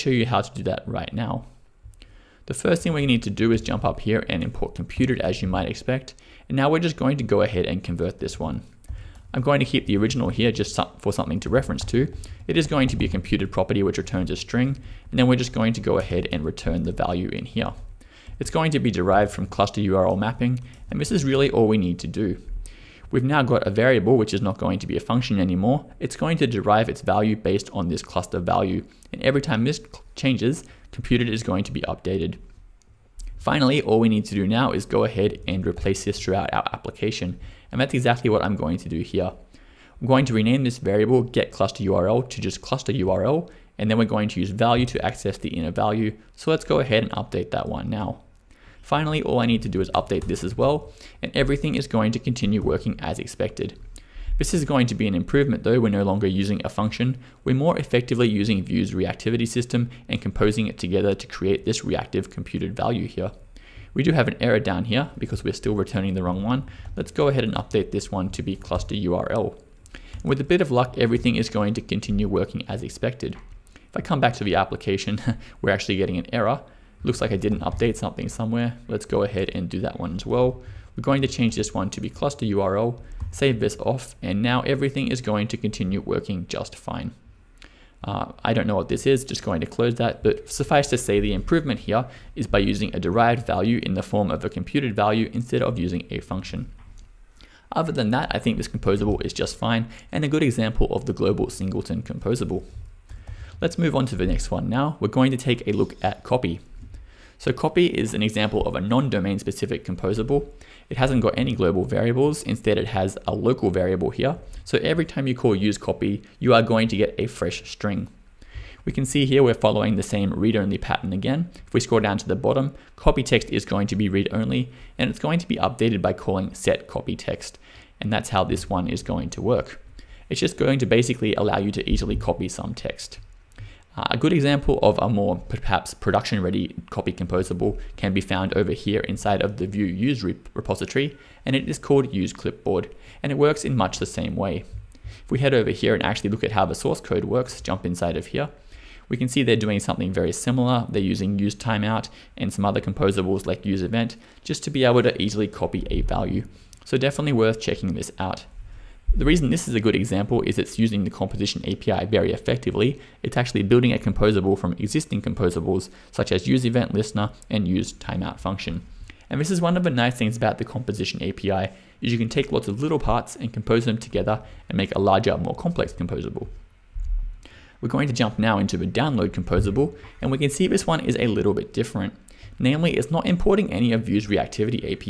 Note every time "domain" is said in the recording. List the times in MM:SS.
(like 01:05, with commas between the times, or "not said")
01:48.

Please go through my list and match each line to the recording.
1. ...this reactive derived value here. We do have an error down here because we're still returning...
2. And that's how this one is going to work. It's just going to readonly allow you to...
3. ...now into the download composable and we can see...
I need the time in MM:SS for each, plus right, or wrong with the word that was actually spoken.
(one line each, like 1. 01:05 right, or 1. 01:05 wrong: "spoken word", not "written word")
1. 01:01 wrong: "computed", not "derived"
2. 02:08 wrong: "basically", not "readonly"
3. 02:58 right.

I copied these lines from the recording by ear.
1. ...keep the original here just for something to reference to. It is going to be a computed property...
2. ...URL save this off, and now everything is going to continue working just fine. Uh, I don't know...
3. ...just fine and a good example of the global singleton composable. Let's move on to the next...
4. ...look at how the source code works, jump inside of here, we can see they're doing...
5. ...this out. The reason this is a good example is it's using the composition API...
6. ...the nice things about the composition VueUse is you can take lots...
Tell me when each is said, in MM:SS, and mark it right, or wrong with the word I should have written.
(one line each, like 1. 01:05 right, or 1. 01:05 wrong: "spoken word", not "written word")
1. 00:09 right
2. 01:22 right
3. 01:39 right
4. 02:26 right
5. 02:37 right
6. 02:49 wrong: "API", not "VueUse".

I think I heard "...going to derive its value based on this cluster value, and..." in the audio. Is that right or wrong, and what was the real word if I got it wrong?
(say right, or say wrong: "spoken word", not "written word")
right.